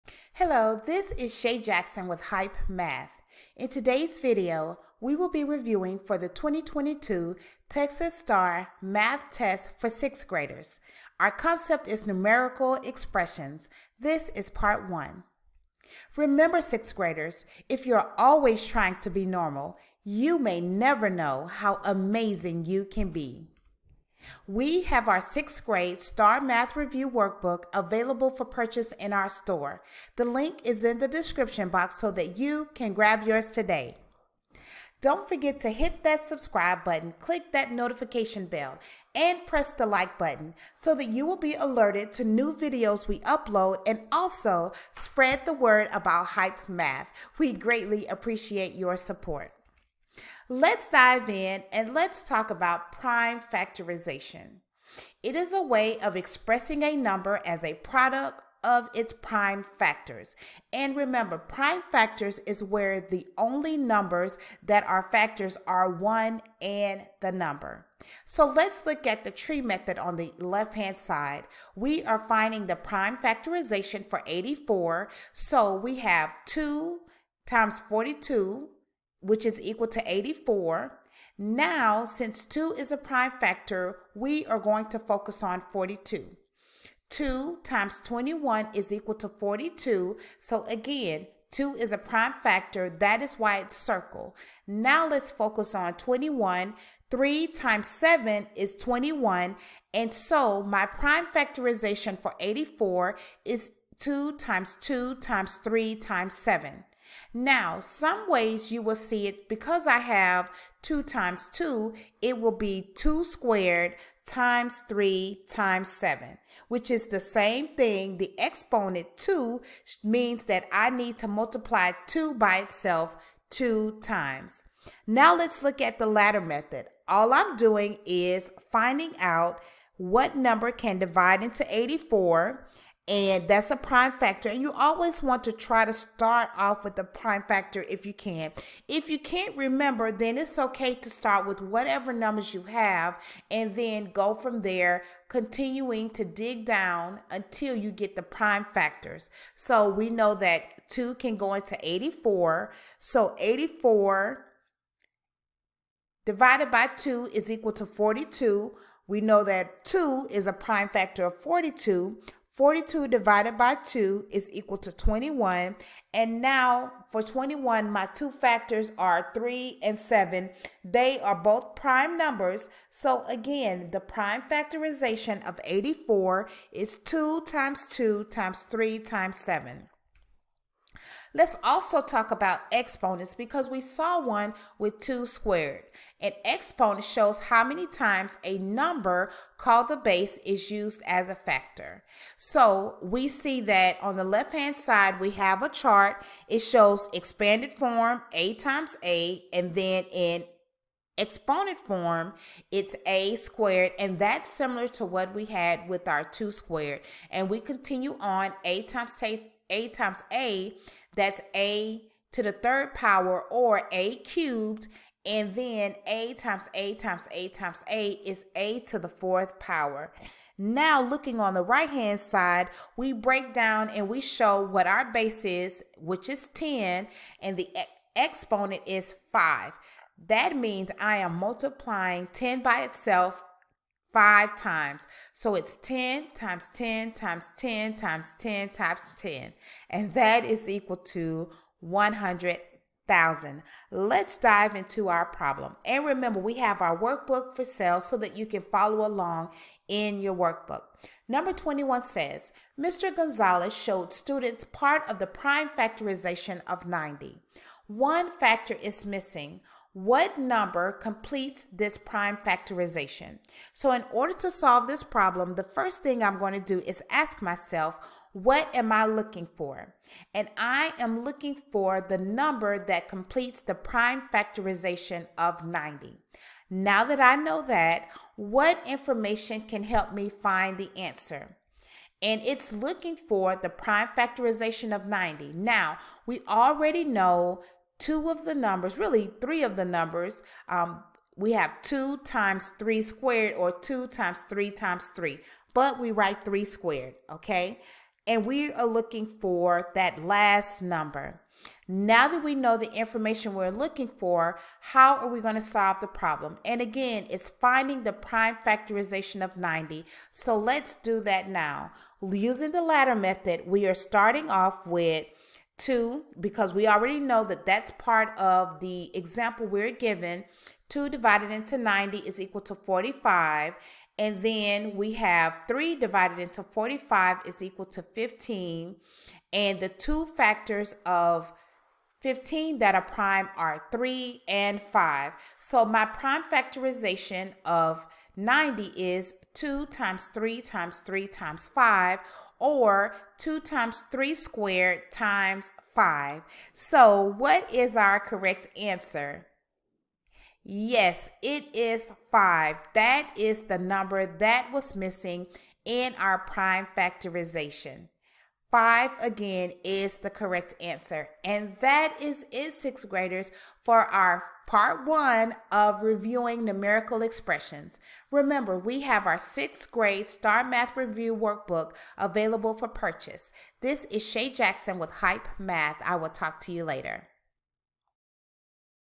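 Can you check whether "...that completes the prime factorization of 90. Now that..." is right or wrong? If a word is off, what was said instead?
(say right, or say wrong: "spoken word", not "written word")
right.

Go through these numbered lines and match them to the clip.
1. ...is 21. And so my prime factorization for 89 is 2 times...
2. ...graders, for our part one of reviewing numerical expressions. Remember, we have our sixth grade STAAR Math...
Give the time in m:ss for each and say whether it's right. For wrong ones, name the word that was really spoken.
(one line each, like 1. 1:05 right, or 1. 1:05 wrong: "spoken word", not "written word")
1. 1:38 wrong: "84", not "89"
2. 6:03 right.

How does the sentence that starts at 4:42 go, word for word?
and it's looking for the prime factorization of 90.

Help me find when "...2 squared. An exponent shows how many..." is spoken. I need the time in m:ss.
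3:04.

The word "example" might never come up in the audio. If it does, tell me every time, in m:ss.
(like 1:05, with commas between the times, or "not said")
5:19.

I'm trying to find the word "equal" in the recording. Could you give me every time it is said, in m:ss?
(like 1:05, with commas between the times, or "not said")
1:19, 1:28, 2:37, 2:44, 4:00, 5:22, 5:27.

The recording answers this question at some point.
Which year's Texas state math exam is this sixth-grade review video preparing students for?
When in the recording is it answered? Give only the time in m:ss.
0:06.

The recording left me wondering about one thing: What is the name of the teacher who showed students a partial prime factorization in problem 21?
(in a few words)
Mr. Gonzalez.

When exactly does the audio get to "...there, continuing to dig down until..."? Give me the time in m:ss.
2:24.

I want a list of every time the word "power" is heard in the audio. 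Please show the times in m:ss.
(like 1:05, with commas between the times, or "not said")
3:32, 3:39.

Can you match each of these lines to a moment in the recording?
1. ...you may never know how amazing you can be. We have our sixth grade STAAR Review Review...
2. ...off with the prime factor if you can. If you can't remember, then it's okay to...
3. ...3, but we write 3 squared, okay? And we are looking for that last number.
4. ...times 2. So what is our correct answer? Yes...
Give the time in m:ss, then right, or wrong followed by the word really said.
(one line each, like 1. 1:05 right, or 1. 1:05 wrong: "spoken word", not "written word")
1. 0:20 wrong: "Math", not "Review"
2. 2:16 right
3. 4:55 right
4. 5:45 wrong: "5", not "2".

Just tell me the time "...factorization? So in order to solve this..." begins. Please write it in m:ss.
4:22.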